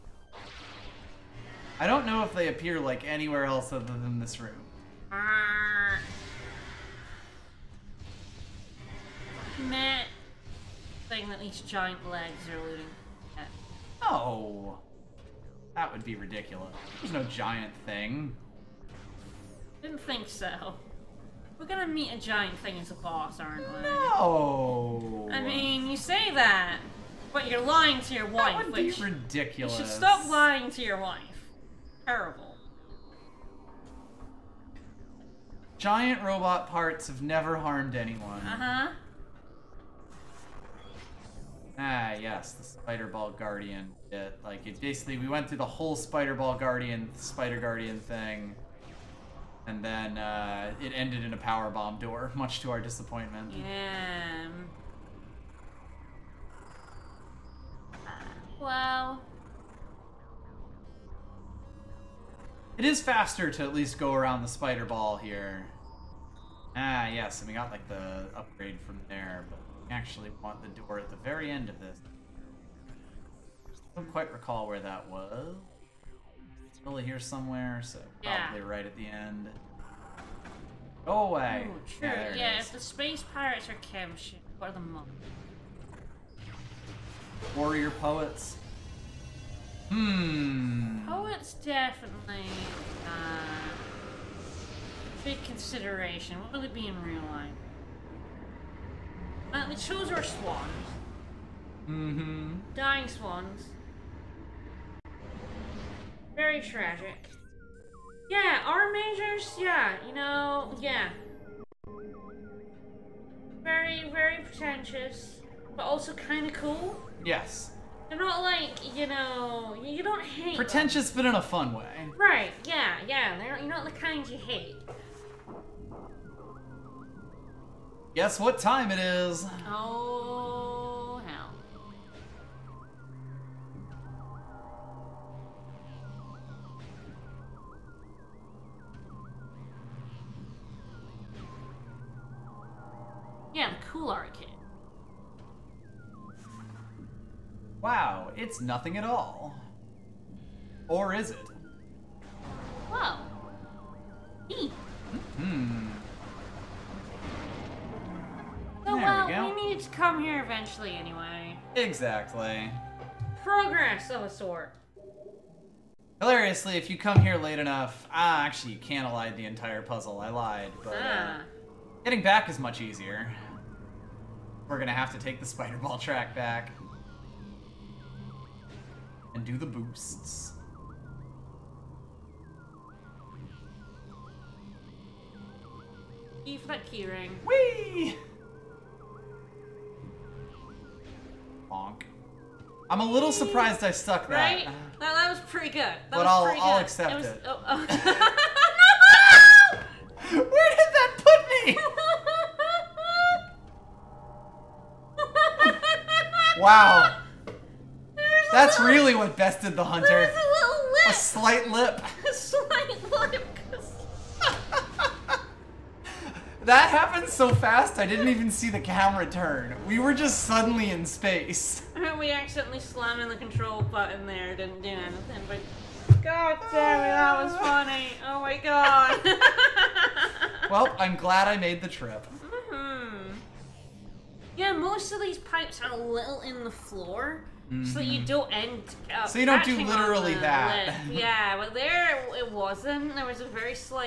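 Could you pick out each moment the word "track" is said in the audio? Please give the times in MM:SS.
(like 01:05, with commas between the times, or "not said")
02:55.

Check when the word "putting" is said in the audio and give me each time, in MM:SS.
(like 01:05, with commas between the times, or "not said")
not said.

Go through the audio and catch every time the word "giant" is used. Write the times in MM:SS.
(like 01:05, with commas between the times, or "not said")
00:11, 00:17, 00:22, 00:35.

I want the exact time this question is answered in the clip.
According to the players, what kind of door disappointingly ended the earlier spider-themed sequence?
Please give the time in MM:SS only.
00:51.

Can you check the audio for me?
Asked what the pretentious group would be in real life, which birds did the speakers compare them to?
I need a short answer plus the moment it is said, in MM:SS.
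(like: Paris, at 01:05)
dying swans, at 01:42.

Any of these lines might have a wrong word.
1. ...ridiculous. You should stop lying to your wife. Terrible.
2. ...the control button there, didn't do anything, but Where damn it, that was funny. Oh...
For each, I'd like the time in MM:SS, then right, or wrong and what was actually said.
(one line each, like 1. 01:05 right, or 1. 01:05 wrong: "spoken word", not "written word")
1. 00:28 right
2. 03:43 wrong: "God", not "Where".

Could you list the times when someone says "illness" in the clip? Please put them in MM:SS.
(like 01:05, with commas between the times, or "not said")
not said.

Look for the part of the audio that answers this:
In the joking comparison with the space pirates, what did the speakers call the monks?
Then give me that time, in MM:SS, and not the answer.
01:27.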